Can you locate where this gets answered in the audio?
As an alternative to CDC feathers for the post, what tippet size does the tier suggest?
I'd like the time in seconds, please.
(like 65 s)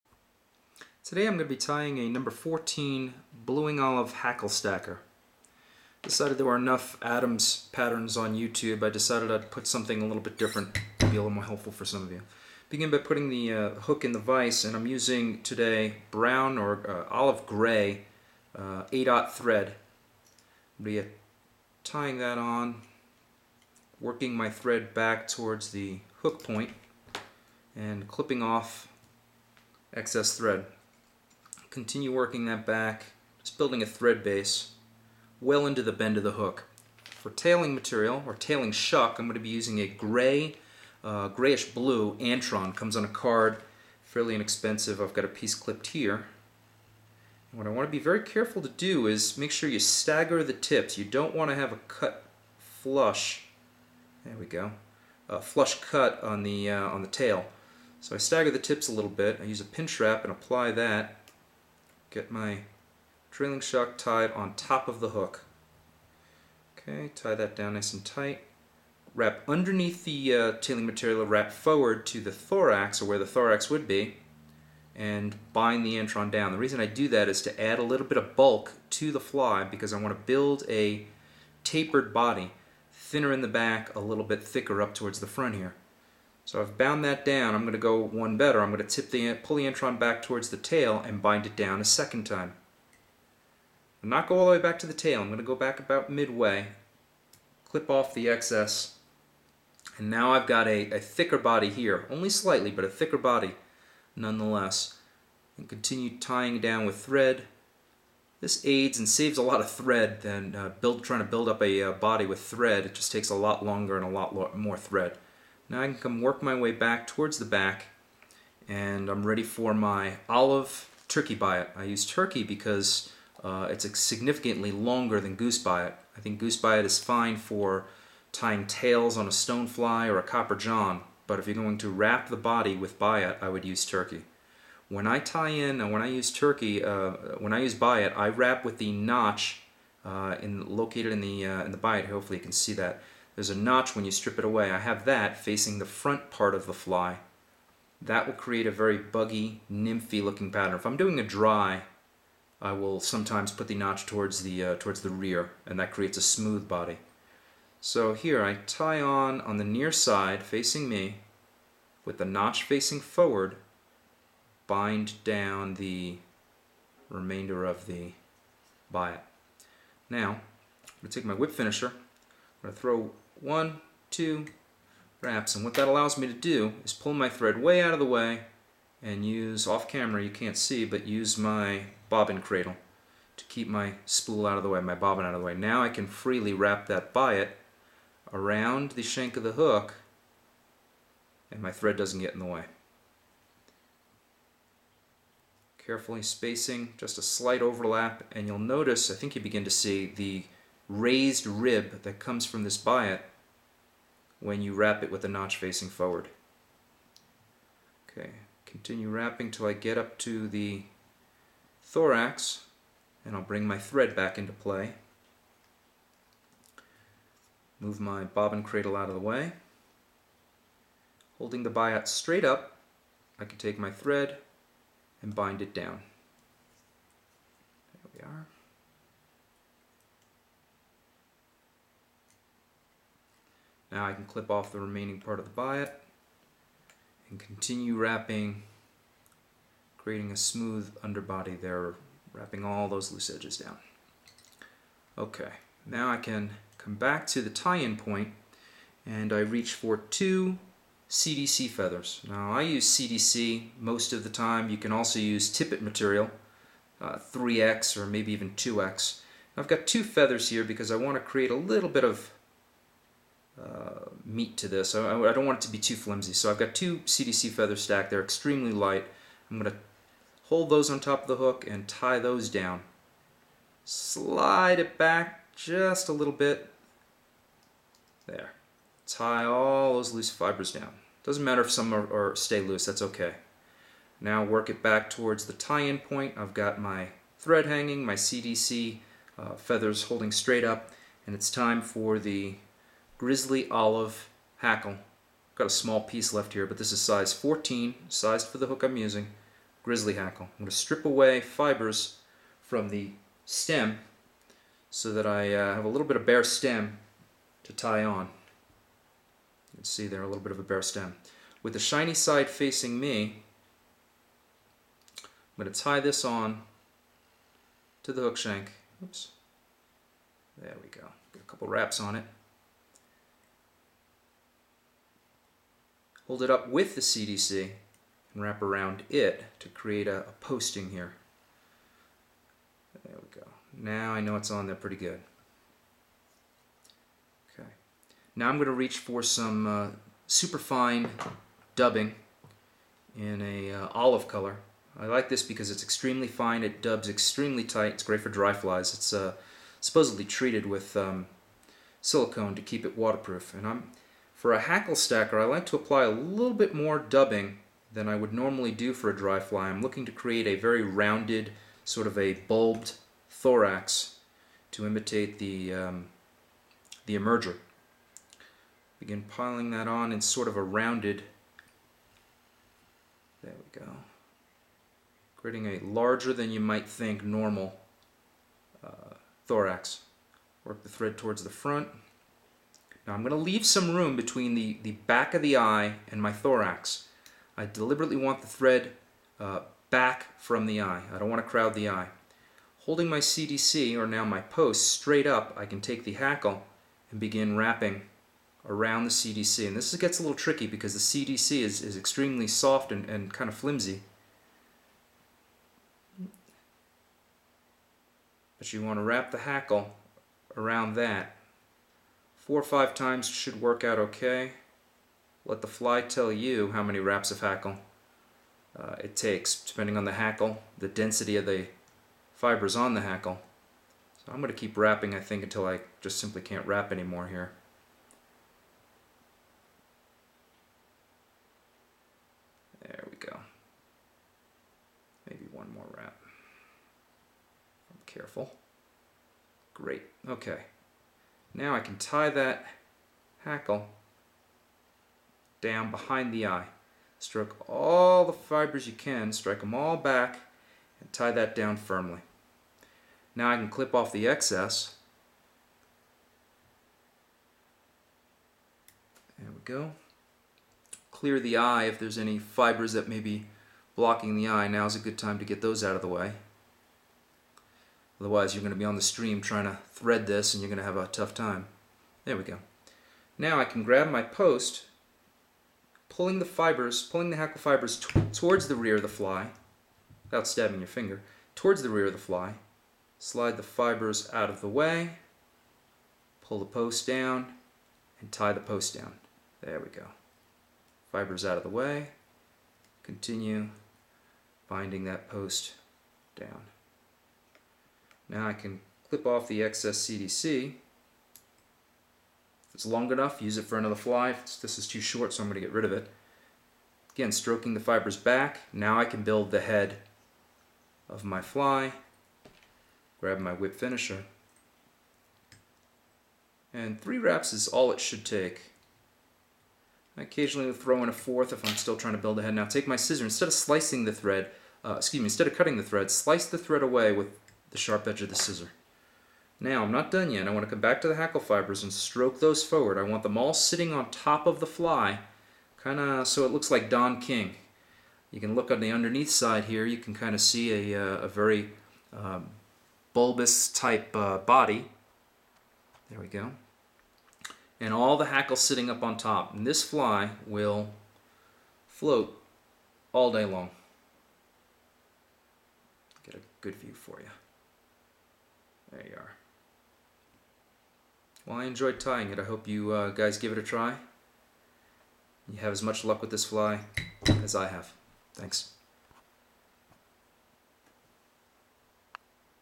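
257 s.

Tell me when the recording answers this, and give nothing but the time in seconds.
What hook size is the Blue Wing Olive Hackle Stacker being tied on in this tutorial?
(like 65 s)
2 s.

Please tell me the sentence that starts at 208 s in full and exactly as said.
Okay, continue wrapping till I get up to the thorax and I'll bring my thread back into play.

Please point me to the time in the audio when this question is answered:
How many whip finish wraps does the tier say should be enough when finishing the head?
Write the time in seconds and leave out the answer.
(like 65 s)
517 s.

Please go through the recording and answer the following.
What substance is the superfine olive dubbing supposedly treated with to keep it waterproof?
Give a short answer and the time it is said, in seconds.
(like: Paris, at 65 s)
Silicone, at 351 s.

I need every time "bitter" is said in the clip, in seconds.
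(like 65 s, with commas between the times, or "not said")
not said.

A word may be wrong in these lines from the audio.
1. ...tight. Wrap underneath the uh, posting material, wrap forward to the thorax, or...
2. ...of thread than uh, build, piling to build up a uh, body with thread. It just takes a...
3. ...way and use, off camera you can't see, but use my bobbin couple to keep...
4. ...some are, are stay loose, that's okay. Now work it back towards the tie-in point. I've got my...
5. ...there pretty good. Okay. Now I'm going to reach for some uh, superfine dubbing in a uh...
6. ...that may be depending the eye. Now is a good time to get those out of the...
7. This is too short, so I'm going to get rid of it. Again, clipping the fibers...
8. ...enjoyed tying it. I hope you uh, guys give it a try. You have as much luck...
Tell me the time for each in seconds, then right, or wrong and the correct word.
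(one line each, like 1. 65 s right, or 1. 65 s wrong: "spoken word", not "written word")
1. 68 s wrong: "tailing", not "posting"
2. 109 s wrong: "trying", not "piling"
3. 178 s wrong: "cradle", not "couple"
4. 281 s right
5. 334 s right
6. 462 s wrong: "blocking", not "depending"
7. 504 s wrong: "stroking", not "clipping"
8. 561 s right.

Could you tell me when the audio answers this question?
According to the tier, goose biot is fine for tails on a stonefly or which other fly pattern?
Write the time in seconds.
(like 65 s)
130 s.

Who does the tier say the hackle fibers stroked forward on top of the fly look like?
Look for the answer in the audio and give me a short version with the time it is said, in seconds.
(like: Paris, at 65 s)
Don King, at 536 s.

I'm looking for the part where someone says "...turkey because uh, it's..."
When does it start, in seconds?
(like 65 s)
122 s.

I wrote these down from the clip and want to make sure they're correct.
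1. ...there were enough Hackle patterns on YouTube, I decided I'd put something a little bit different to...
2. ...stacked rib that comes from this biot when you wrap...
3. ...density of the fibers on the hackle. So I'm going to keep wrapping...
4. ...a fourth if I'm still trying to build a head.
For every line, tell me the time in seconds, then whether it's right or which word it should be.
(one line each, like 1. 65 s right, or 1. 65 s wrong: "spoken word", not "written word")
1. 6 s wrong: "Adams", not "Hackle"
2. 200 s wrong: "raised", not "stacked"
3. 420 s right
4. 521 s right.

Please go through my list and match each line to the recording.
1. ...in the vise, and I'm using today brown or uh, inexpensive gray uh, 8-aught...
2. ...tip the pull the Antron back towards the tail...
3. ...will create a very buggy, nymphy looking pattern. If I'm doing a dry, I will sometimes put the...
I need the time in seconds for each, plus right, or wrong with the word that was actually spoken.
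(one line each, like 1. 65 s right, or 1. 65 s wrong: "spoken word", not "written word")
1. 14 s wrong: "olive", not "inexpensive"
2. 89 s right
3. 148 s right.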